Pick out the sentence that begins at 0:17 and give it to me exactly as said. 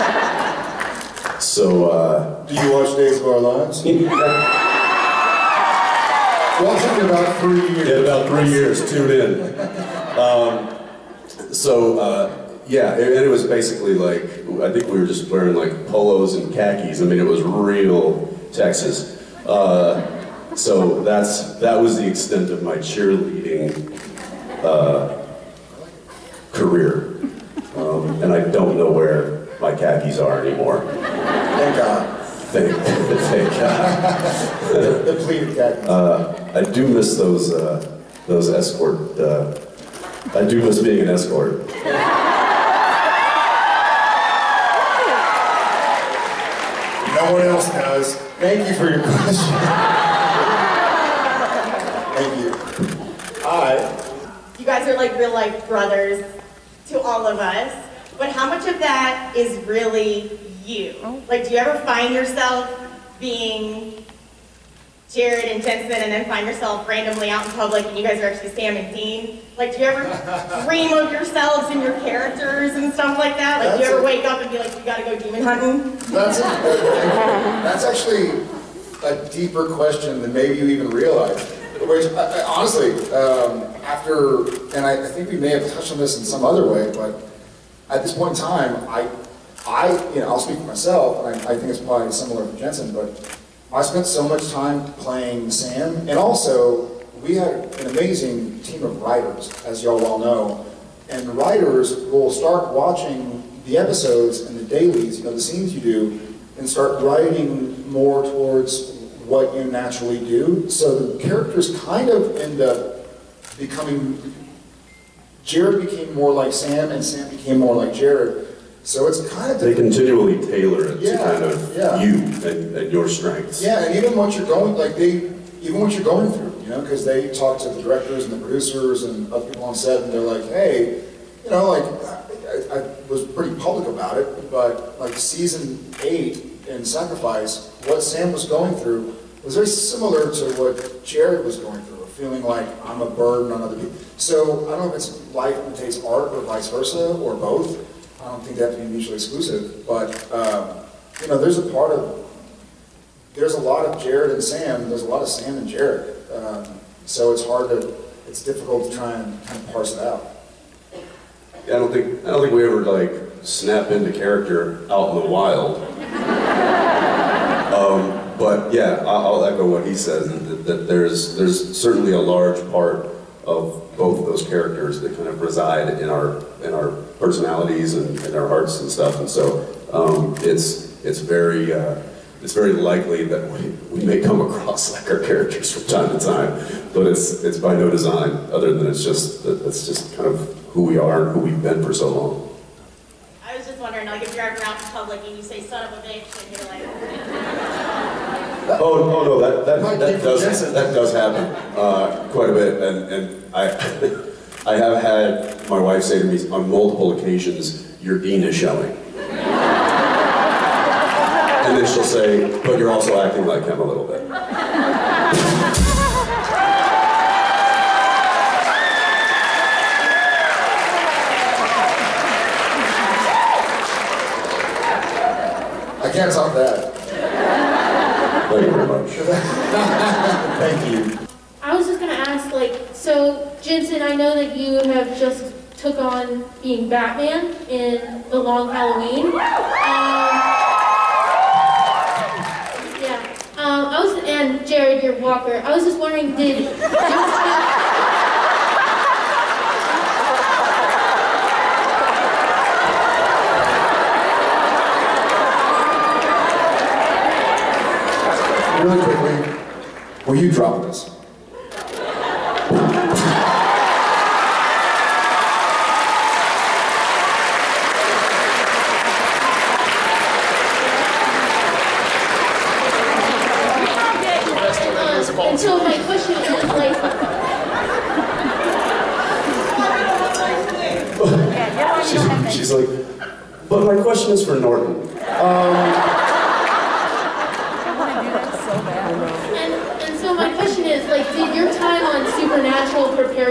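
I mean, it was real Texas.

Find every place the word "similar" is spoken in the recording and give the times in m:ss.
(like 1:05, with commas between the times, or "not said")
1:32, 2:19.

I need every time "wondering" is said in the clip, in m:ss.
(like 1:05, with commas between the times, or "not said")
3:13, 4:05.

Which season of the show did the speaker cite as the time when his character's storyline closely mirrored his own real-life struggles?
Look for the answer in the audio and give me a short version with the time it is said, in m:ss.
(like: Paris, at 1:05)
Season 8, at 2:15.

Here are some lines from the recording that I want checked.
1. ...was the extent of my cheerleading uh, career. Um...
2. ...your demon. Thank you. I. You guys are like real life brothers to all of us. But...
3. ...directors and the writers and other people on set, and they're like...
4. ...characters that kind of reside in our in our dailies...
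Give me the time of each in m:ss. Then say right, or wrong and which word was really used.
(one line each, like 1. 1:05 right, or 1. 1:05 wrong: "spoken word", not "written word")
1. 0:21 right
2. 0:48 wrong: "question", not "demon"
3. 2:07 wrong: "producers", not "writers"
4. 2:54 wrong: "personalities", not "dailies".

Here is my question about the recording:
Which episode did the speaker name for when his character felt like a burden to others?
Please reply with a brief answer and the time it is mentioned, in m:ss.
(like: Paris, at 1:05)
Sacrifice, at 2:16.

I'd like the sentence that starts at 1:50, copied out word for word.
So the characters kind of end up becoming, Jared became more like Sam, and Sam became more like Jared.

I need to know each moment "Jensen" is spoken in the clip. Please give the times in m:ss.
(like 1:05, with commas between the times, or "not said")
1:05, 1:32, 3:53.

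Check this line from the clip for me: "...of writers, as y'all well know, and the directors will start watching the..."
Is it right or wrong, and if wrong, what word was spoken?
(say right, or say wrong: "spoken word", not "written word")
wrong: "writers", not "directors".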